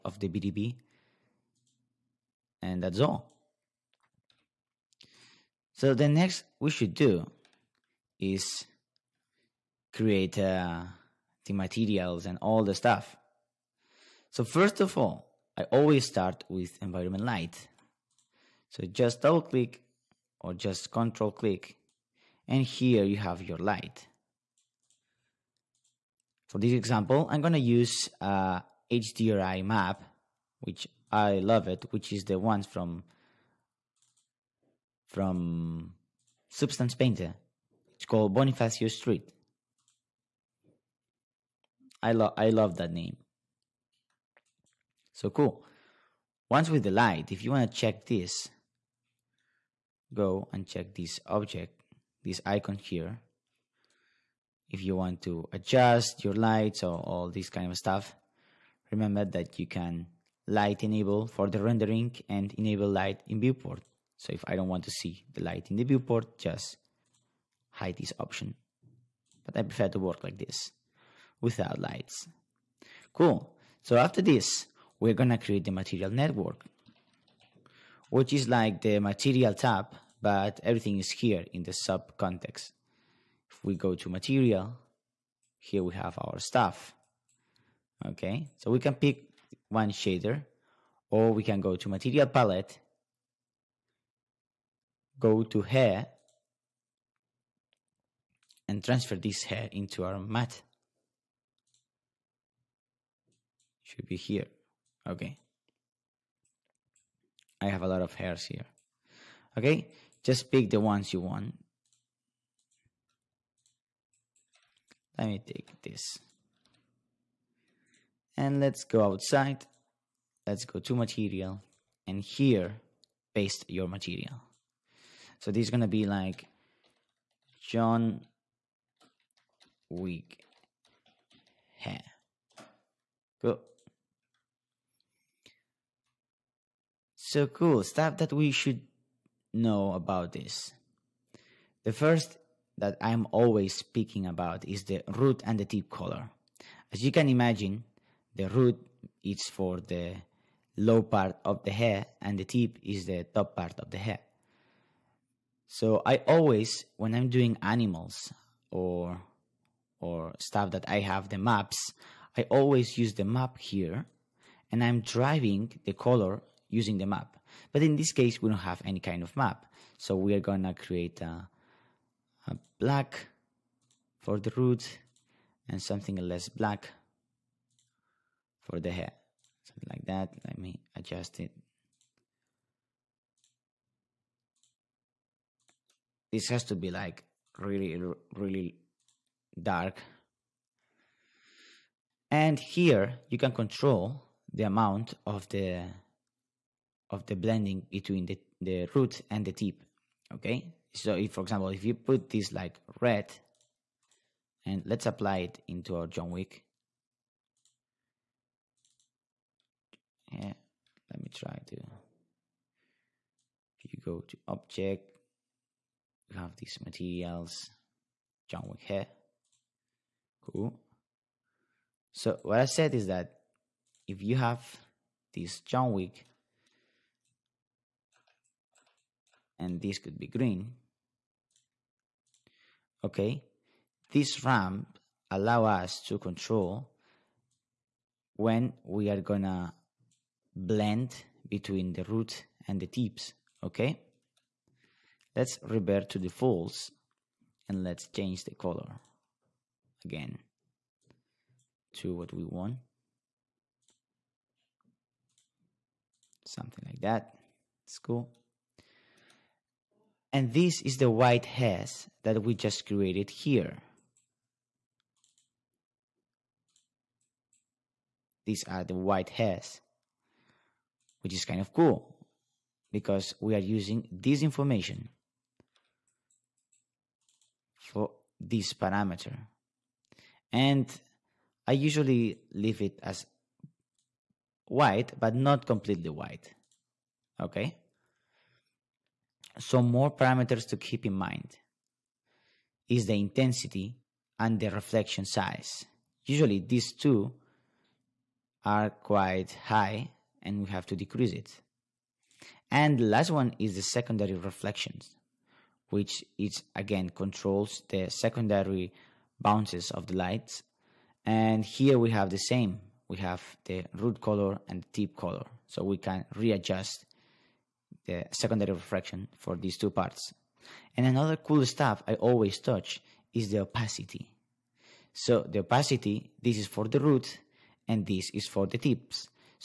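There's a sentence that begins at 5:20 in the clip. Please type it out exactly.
And another cool stuff I always touch is the opacity.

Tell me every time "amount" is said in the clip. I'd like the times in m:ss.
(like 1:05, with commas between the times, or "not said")
3:14.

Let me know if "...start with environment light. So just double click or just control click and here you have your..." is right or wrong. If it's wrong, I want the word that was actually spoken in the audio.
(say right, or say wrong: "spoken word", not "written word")
right.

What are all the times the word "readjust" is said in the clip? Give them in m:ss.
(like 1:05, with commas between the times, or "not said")
5:16.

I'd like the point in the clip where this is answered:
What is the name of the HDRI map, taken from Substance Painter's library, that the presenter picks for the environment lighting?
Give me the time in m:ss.
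0:38.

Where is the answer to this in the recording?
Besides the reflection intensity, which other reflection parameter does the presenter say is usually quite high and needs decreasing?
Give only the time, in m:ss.
4:54.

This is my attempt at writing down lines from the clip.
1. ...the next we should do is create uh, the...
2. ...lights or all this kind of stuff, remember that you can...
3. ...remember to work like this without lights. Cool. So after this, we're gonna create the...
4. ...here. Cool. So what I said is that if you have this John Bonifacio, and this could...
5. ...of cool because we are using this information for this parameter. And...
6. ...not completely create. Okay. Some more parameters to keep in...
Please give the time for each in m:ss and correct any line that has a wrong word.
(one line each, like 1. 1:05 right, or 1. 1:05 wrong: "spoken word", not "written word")
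1. 0:05 right
2. 0:56 right
3. 1:09 wrong: "prefer", not "remember"
4. 3:38 wrong: "Wick", not "Bonifacio"
5. 4:31 right
6. 4:45 wrong: "white", not "create".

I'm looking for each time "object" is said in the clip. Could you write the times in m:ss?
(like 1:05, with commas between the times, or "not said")
0:51, 3:34.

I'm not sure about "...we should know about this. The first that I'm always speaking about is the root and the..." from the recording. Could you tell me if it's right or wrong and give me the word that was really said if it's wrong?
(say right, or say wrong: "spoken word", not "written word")
right.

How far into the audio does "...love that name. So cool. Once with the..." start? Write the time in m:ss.
0:42.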